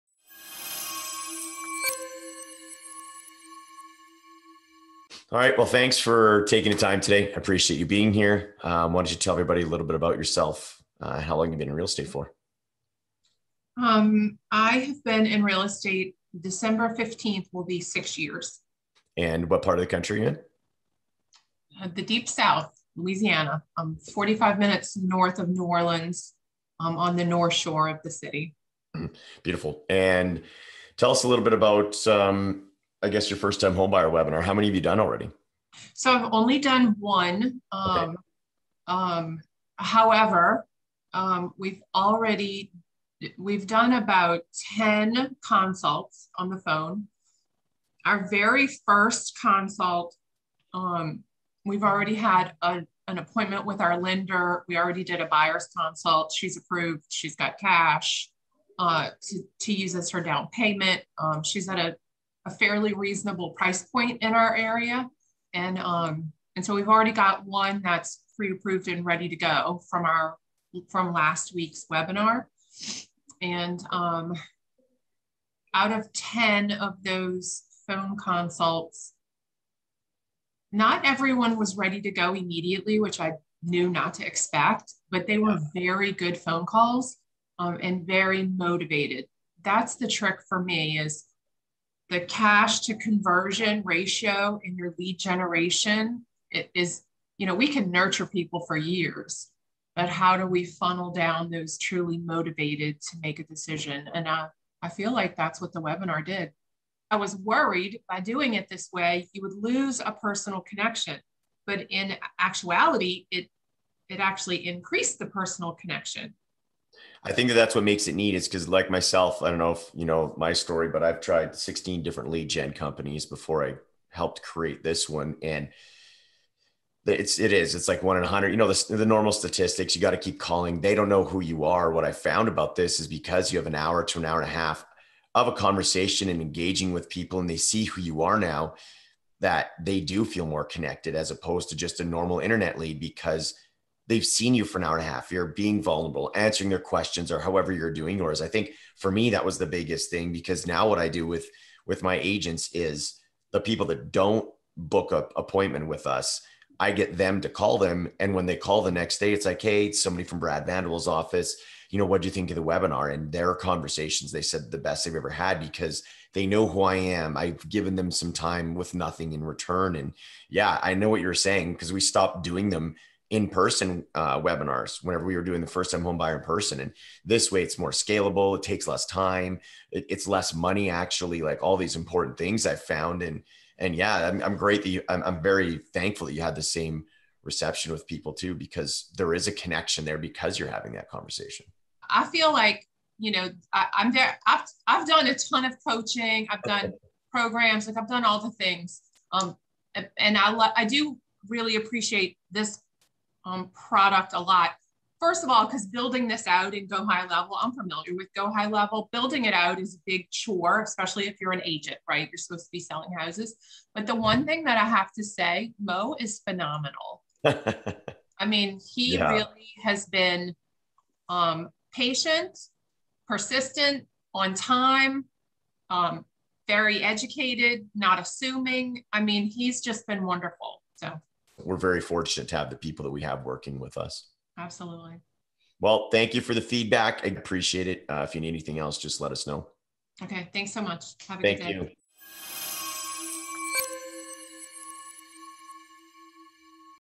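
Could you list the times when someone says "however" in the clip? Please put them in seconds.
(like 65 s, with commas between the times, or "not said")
39 s, 147 s.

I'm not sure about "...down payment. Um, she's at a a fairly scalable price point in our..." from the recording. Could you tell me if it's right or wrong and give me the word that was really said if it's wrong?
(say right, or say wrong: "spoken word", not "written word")
wrong: "reasonable", not "scalable".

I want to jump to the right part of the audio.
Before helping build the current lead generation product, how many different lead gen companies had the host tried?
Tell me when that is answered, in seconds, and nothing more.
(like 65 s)
121 s.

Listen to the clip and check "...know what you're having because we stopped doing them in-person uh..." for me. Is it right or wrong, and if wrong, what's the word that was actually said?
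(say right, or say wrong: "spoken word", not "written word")
wrong: "saying", not "having".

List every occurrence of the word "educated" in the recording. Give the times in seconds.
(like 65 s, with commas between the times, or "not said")
227 s.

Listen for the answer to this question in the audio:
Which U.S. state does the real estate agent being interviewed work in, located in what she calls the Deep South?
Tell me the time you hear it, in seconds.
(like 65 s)
22 s.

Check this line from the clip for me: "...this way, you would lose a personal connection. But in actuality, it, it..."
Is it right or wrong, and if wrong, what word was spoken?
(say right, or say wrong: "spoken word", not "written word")
right.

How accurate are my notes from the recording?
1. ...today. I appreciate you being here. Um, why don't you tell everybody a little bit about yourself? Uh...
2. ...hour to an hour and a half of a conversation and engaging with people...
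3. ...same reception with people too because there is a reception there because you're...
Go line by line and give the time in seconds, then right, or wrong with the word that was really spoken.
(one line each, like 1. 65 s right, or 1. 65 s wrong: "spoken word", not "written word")
1. 6 s right
2. 133 s right
3. 186 s wrong: "connection", not "reception".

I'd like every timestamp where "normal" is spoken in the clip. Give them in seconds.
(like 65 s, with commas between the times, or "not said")
129 s, 142 s.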